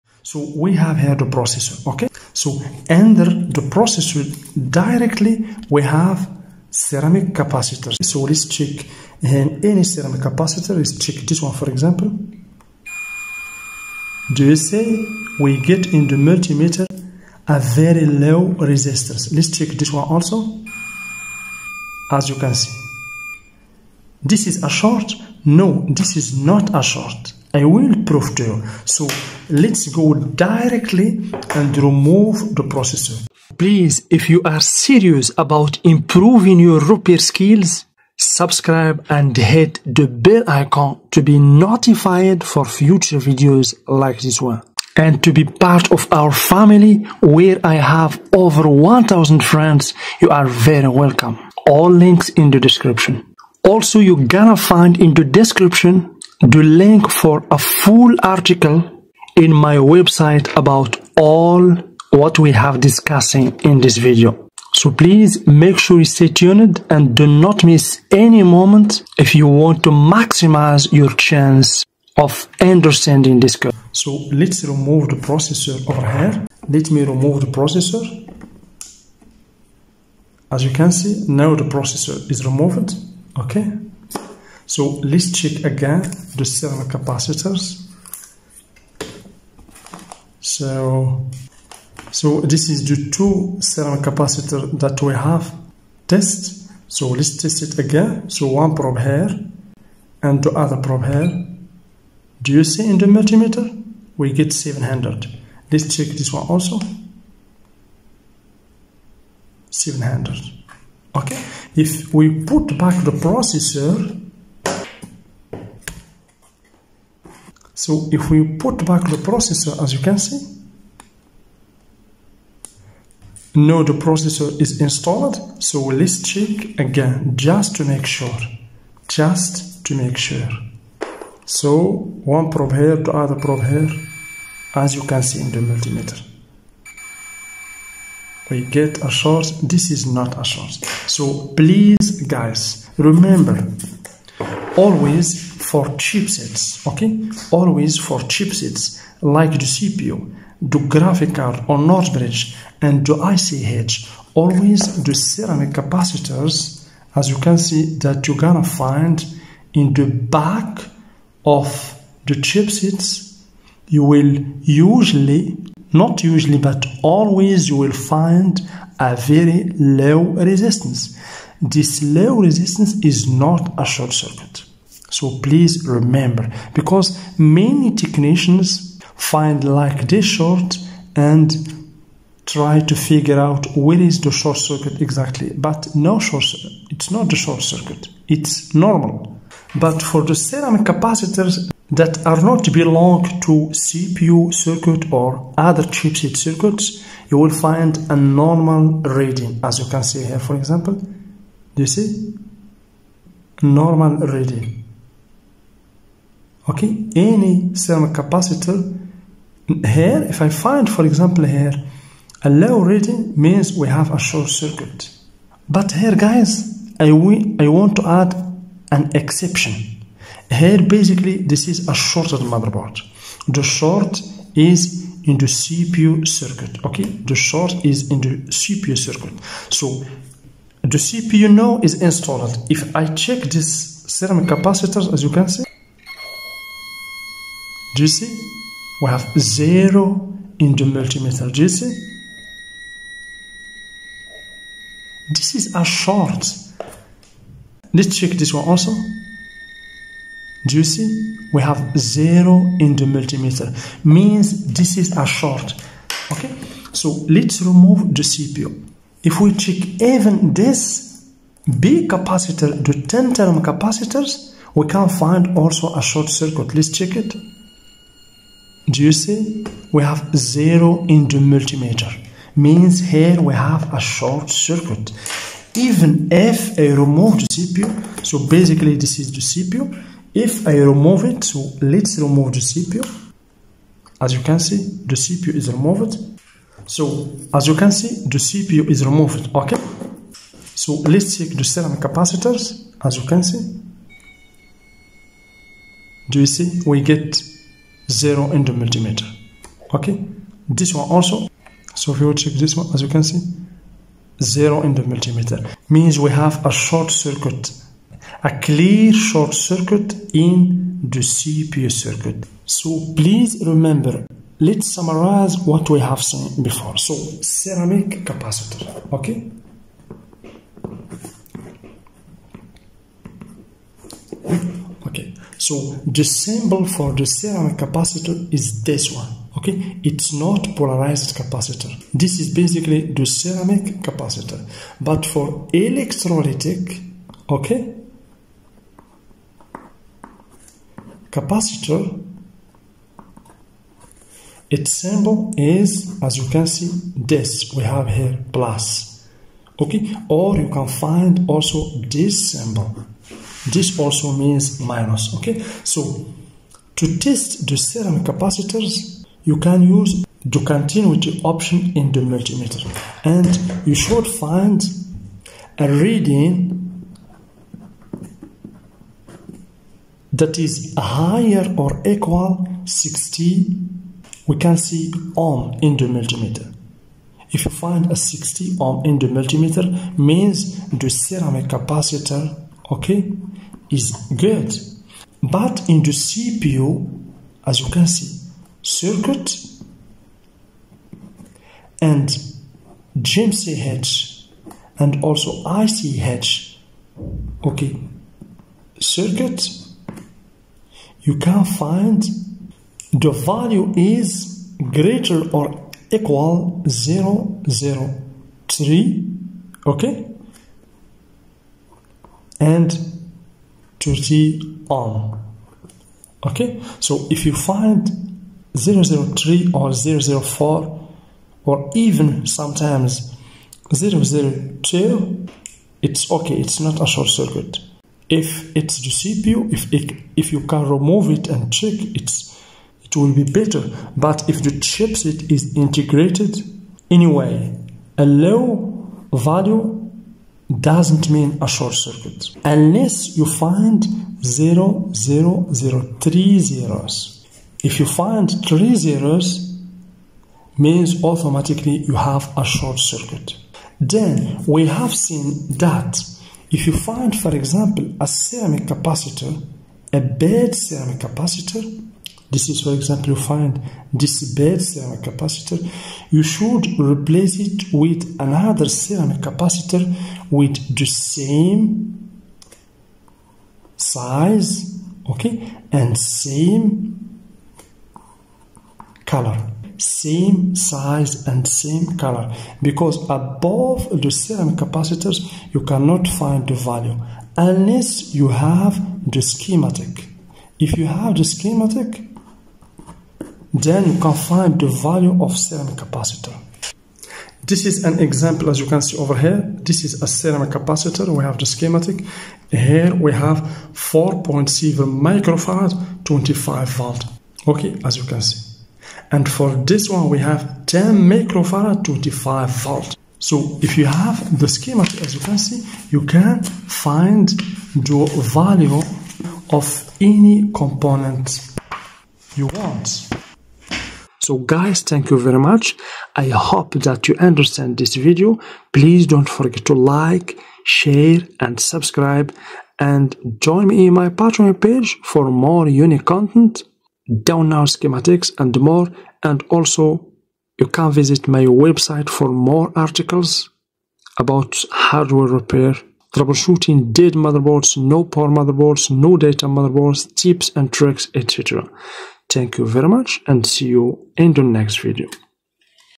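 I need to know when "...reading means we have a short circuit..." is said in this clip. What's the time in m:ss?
3:32.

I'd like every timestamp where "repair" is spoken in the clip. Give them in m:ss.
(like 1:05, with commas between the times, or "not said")
0:36, 9:05.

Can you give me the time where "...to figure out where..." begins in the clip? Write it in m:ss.
3:02.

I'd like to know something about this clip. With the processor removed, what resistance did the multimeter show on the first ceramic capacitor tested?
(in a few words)
700.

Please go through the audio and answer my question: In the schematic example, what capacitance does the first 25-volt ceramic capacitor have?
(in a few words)
4.7 microfarad.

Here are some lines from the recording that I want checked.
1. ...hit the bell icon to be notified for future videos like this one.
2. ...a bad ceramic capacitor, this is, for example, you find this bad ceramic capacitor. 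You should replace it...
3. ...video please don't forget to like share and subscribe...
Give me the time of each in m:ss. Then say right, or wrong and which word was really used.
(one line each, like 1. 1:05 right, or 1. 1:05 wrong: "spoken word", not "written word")
1. 0:39 right
2. 7:40 right
3. 8:48 right.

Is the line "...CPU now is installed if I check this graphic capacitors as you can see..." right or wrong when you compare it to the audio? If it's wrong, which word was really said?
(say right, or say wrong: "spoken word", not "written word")
wrong: "ceramic", not "graphic".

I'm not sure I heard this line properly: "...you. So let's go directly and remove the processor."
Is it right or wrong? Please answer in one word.
right.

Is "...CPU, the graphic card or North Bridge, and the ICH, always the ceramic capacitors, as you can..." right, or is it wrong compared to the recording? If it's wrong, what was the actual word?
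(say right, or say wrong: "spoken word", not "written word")
right.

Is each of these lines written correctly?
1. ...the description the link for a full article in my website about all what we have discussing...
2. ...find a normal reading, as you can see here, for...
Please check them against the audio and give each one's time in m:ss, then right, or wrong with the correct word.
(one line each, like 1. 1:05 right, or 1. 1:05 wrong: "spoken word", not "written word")
1. 0:55 right
2. 3:17 right.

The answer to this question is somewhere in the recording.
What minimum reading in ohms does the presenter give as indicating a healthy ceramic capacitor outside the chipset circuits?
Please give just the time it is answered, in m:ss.
6:10.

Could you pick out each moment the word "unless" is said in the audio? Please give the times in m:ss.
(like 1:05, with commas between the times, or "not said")
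7:22, 8:07.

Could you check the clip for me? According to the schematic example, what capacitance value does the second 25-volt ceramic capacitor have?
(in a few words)
10 microfarad.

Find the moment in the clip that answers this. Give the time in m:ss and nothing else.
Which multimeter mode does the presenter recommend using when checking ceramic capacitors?
6:00.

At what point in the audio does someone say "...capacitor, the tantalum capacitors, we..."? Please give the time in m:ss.
4:22.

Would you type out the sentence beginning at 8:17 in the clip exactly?
This is an example as you can see over here.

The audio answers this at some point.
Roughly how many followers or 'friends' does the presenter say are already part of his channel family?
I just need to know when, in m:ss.
0:48.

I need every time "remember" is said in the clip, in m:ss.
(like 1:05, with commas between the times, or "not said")
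2:22, 2:55, 5:13.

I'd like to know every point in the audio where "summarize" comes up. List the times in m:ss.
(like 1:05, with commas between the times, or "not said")
5:14.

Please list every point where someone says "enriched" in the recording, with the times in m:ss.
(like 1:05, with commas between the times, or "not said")
not said.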